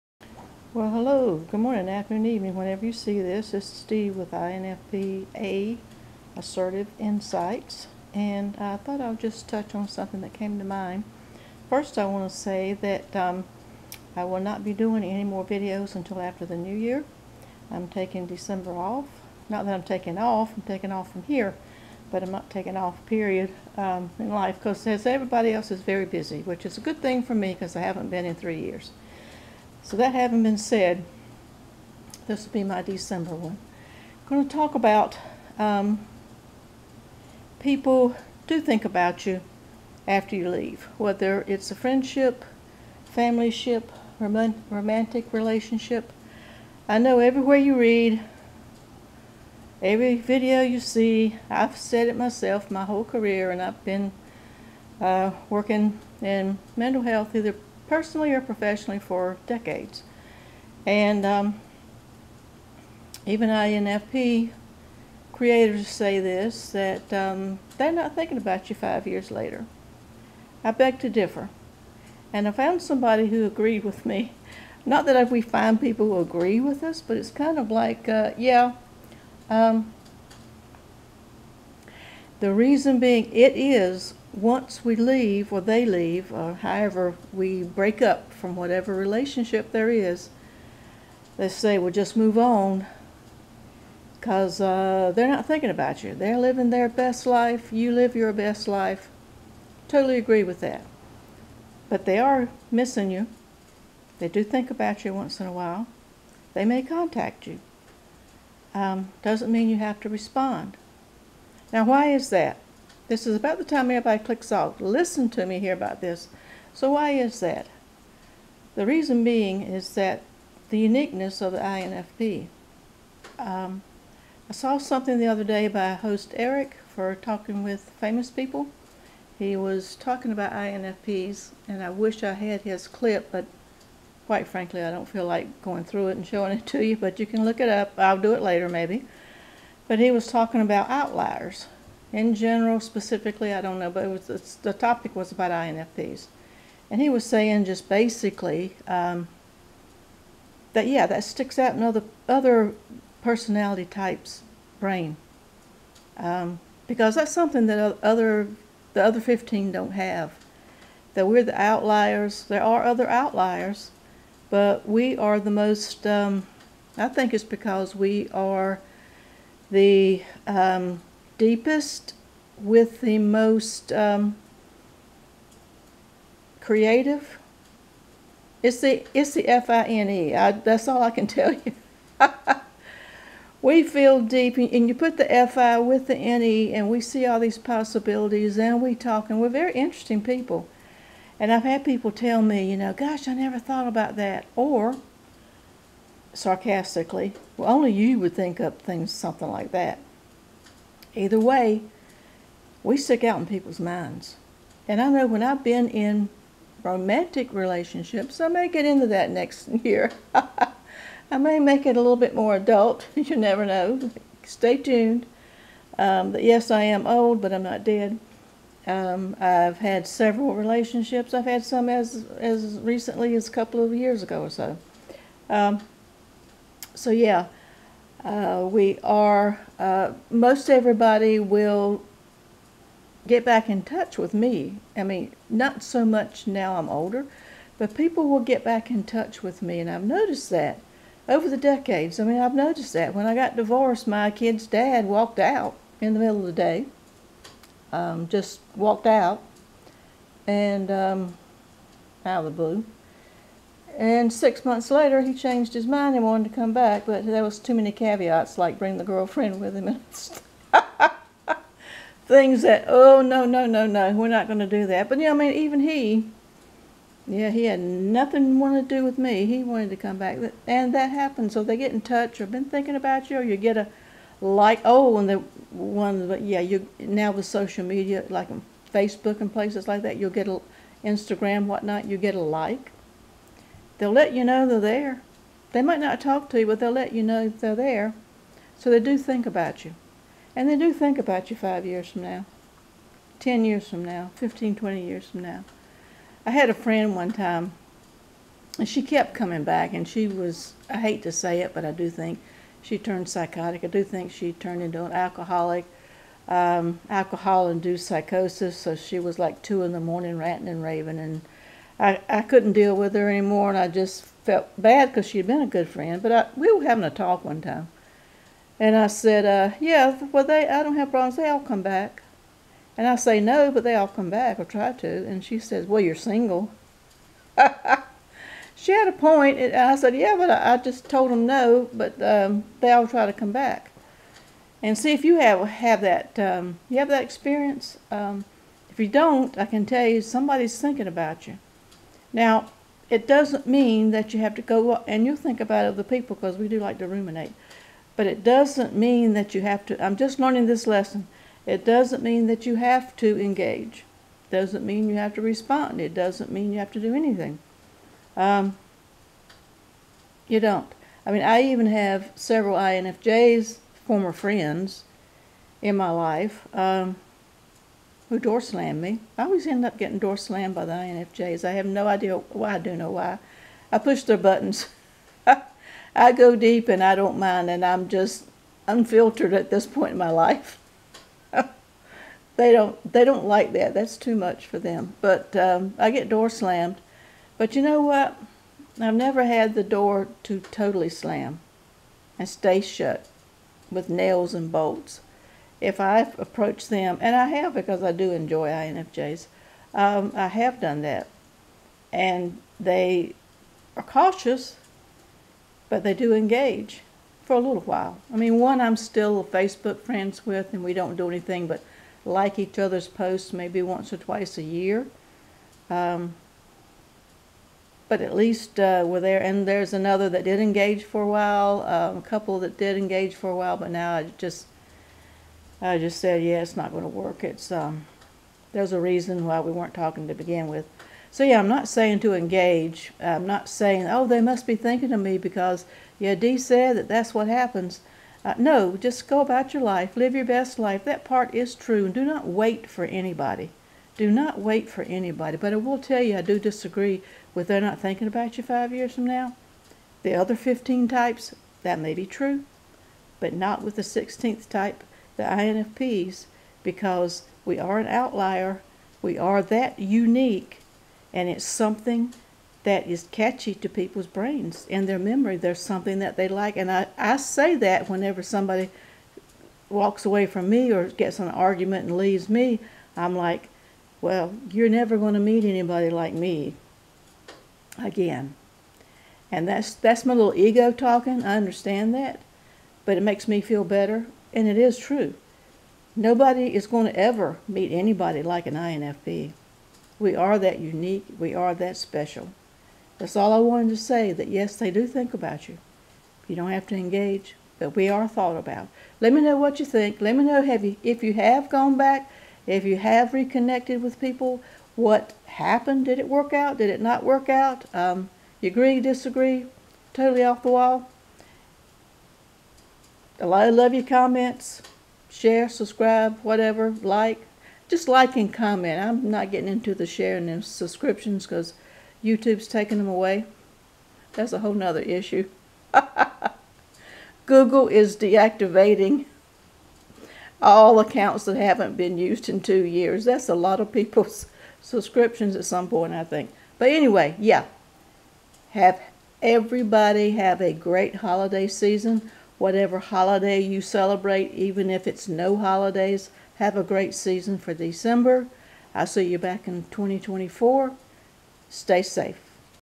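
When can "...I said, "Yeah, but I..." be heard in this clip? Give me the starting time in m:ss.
5:29.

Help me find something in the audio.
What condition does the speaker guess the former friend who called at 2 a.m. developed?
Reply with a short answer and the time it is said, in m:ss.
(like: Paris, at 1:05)
alcohol induced psychosis, at 5:07.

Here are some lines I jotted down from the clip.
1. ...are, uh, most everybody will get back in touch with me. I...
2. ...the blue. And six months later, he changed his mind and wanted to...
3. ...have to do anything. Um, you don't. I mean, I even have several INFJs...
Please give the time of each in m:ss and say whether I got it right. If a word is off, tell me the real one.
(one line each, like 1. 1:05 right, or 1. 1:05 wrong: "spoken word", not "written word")
1. 3:49 right
2. 4:12 right
3. 5:56 right.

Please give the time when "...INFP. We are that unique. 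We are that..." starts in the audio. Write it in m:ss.
8:08.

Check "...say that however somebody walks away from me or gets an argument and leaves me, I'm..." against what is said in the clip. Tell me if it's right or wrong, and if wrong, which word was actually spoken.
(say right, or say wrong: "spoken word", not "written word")
wrong: "whenever", not "however".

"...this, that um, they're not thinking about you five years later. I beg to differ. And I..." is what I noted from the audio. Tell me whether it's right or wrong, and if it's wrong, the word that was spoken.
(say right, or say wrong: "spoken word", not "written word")
right.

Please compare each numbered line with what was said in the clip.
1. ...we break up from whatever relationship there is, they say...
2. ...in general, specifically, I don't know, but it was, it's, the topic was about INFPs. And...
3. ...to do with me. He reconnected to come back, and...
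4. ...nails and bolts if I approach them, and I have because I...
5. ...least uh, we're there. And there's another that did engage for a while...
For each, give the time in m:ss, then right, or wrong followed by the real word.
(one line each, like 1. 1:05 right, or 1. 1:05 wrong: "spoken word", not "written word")
1. 1:27 right
2. 2:22 right
3. 4:28 wrong: "wanted", not "reconnected"
4. 6:34 right
5. 6:58 right.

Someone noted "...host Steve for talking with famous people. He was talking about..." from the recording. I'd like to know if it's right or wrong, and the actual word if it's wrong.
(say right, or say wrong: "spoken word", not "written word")
wrong: "Eric", not "Steve".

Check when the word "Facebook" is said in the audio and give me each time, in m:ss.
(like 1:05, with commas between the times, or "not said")
4:38, 6:49.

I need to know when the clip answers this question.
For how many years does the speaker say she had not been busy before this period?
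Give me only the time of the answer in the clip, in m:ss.
0:28.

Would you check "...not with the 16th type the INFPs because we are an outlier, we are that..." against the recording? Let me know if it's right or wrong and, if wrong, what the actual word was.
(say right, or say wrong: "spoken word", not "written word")
right.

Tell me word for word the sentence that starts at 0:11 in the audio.
First, I want to say that um, I will not be doing any more videos until after the new year.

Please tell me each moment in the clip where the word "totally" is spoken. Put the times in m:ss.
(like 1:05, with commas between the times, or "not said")
1:39, 6:30, 8:30.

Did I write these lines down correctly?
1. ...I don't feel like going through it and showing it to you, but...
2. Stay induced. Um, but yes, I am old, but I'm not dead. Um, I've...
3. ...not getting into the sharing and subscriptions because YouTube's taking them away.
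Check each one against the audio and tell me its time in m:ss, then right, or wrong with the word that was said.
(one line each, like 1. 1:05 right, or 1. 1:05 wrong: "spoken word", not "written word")
1. 2:14 right
2. 3:34 wrong: "tuned", not "induced"
3. 8:39 right.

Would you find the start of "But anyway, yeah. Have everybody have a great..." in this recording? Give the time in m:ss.
8:56.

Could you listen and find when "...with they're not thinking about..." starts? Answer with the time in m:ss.
7:27.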